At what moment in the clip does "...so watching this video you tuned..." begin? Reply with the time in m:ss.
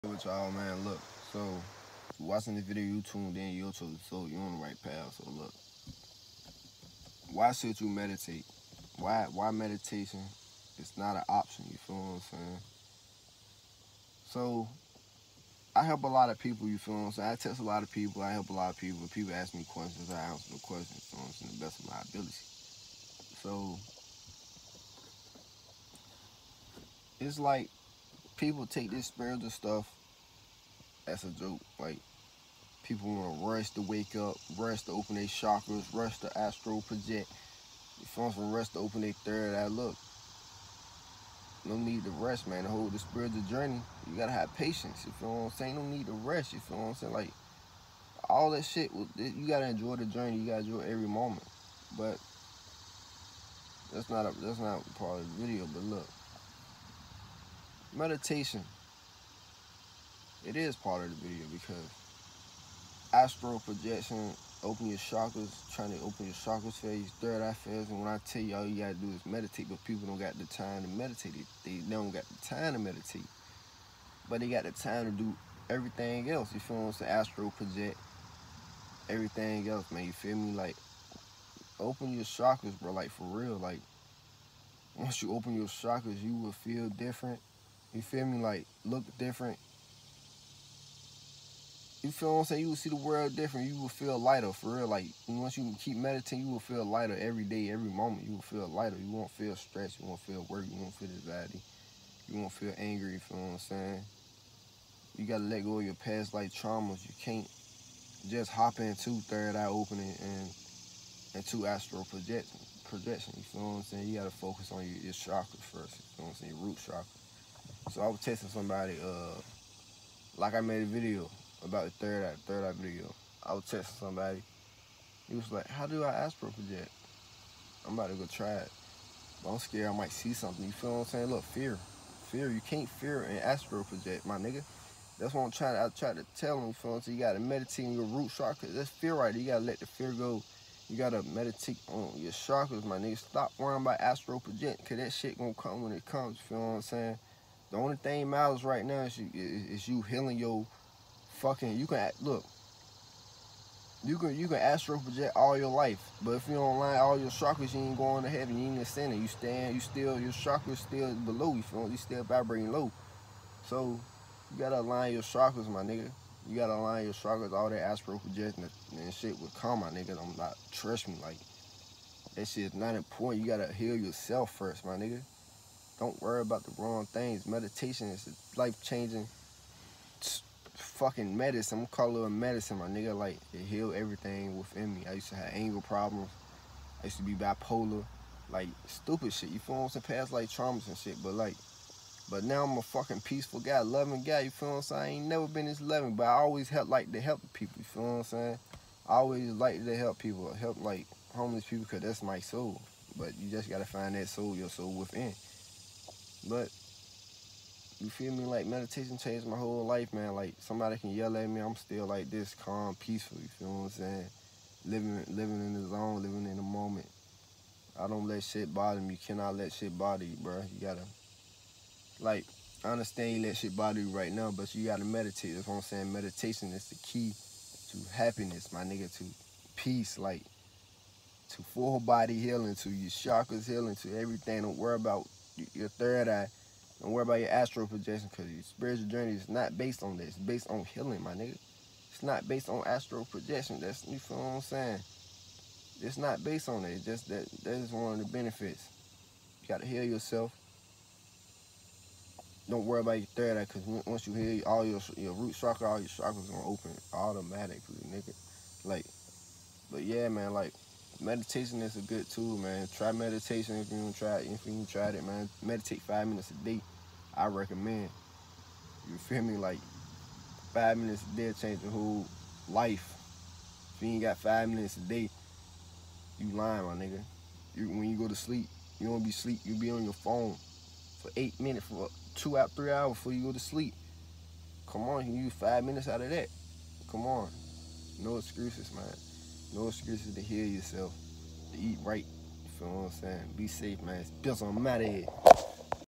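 0:01.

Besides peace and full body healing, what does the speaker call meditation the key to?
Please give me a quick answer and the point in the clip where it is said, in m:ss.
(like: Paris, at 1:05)
happiness, at 3:48.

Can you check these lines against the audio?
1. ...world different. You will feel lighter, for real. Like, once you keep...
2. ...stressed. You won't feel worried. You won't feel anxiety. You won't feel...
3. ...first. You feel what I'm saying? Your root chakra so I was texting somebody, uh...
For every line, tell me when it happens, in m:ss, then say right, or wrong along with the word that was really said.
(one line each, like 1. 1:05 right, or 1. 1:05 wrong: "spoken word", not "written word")
1. 1:32 right
2. 1:39 right
3. 1:55 right.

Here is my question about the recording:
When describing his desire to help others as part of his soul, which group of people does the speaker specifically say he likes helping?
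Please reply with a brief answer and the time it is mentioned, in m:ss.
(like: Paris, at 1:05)
homeless people, at 3:21.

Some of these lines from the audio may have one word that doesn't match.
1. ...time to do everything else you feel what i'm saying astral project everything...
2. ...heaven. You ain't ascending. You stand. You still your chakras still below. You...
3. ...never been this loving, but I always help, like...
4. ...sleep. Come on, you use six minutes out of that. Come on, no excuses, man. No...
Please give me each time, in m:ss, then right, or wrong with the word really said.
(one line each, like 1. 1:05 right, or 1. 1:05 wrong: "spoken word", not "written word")
1. 1:14 right
2. 2:38 right
3. 3:15 right
4. 4:43 wrong: "five", not "six".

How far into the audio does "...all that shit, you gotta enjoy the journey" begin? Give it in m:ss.
0:48.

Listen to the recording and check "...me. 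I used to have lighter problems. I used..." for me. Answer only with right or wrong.
wrong.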